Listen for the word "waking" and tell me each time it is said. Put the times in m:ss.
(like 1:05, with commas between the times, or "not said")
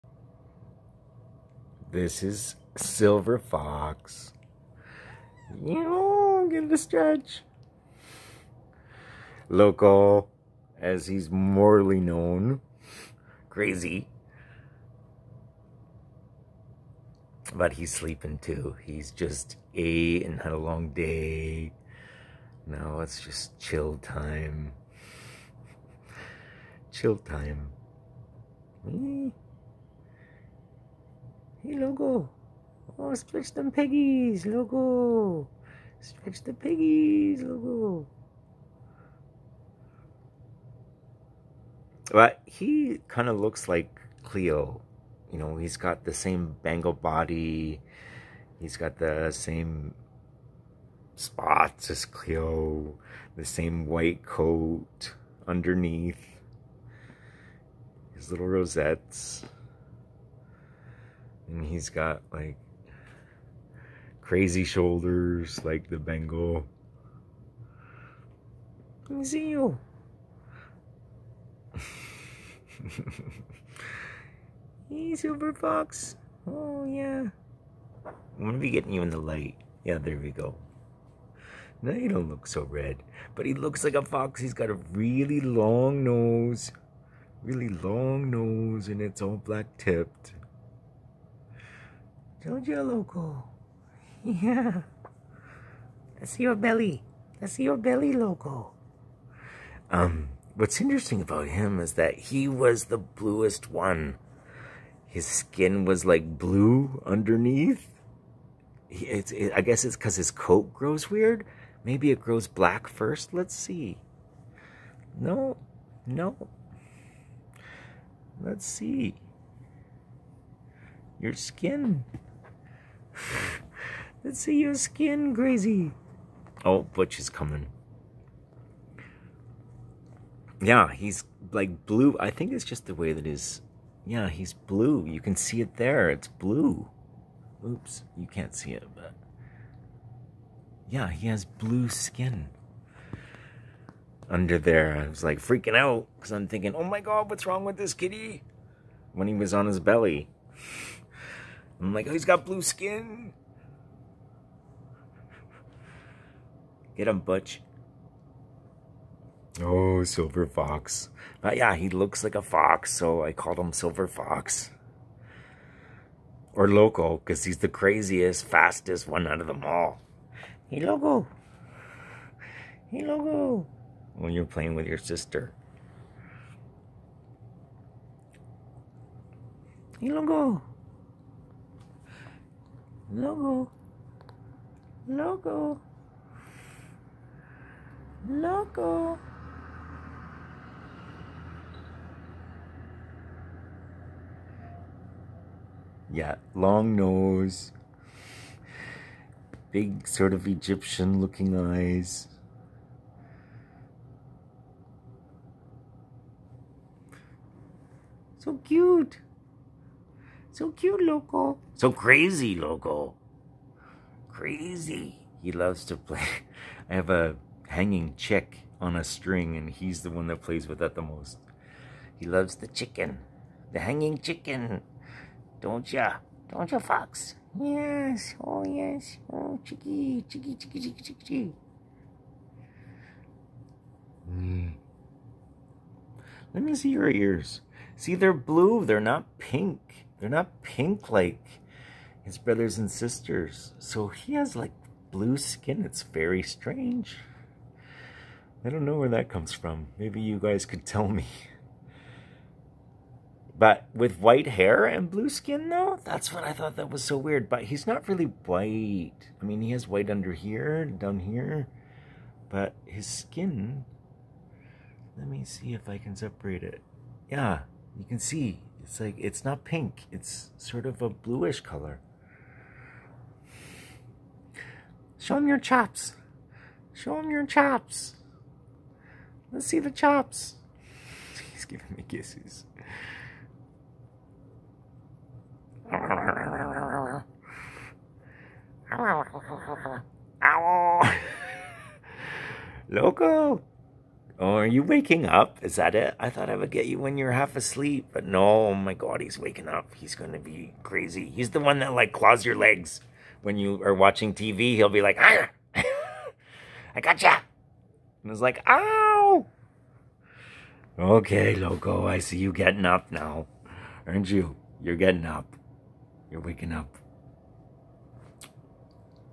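4:54, 4:59, 5:16.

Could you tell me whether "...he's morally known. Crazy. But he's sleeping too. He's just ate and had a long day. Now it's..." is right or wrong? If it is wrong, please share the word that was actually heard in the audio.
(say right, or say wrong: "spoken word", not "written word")
right.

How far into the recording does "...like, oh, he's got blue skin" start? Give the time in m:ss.
2:31.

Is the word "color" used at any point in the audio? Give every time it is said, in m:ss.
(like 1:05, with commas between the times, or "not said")
4:31.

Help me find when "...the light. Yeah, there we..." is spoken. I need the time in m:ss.
1:19.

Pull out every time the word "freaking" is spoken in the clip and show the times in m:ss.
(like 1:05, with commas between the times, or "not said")
2:25.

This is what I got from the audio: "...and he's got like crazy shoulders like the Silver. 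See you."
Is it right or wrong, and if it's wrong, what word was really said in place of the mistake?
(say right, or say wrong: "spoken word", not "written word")
wrong: "Bengal", not "Silver".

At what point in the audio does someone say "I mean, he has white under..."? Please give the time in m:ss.
4:19.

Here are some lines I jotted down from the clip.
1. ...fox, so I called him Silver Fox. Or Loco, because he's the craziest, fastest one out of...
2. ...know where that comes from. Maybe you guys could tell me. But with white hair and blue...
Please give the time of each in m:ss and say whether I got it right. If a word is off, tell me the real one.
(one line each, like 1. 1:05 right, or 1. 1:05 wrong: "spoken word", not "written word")
1. 2:42 right
2. 4:08 right.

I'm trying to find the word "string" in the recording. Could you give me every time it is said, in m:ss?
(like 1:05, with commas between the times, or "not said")
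3:39.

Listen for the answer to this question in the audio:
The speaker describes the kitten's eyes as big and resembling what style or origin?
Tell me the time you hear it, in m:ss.
3:20.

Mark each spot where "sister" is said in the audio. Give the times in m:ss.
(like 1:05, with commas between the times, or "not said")
2:54, 4:02.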